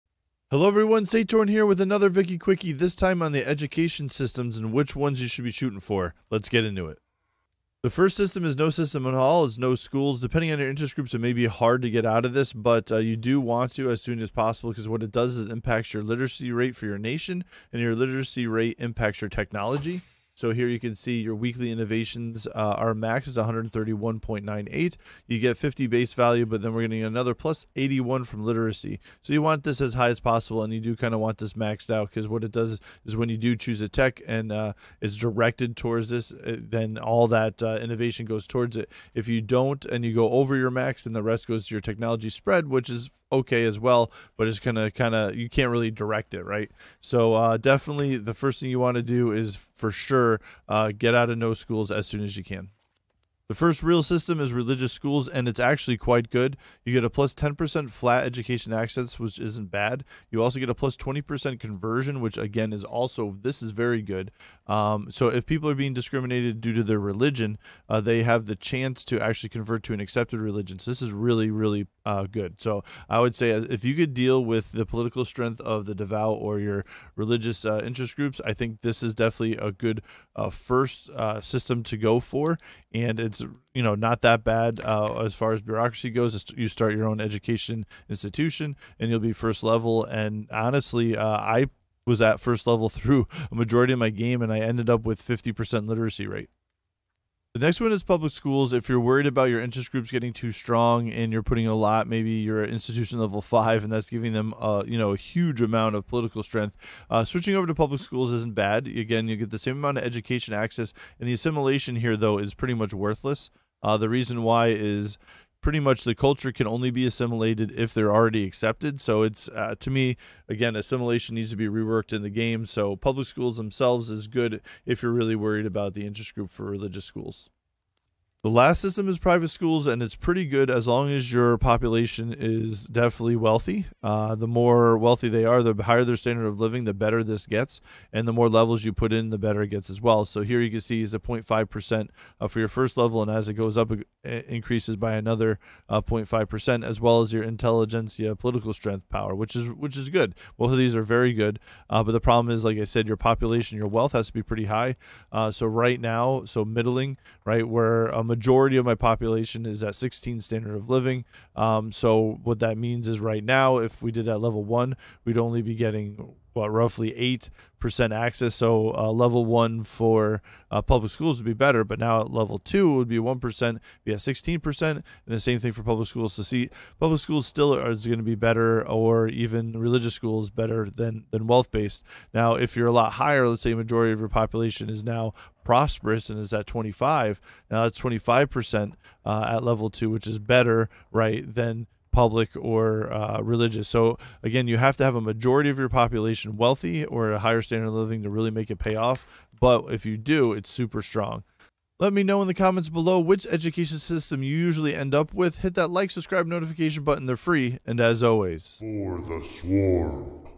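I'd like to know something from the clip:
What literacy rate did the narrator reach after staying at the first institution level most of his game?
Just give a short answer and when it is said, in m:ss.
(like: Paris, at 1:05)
50%, at 1:35.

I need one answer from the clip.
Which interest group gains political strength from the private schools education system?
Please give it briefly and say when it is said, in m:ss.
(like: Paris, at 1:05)
intelligentsia, at 2:27.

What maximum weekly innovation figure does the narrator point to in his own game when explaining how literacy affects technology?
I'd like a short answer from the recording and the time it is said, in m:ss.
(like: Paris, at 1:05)
131.98, at 0:23.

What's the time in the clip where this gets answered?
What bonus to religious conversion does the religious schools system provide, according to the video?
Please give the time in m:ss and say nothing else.
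1:00.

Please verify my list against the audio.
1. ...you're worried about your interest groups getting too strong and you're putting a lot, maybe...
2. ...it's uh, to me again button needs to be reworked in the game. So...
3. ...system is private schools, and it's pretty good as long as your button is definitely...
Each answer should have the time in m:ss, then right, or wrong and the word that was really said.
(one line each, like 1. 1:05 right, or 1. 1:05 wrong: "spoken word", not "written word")
1. 1:38 right
2. 1:59 wrong: "assimilation", not "button"
3. 2:08 wrong: "population", not "button".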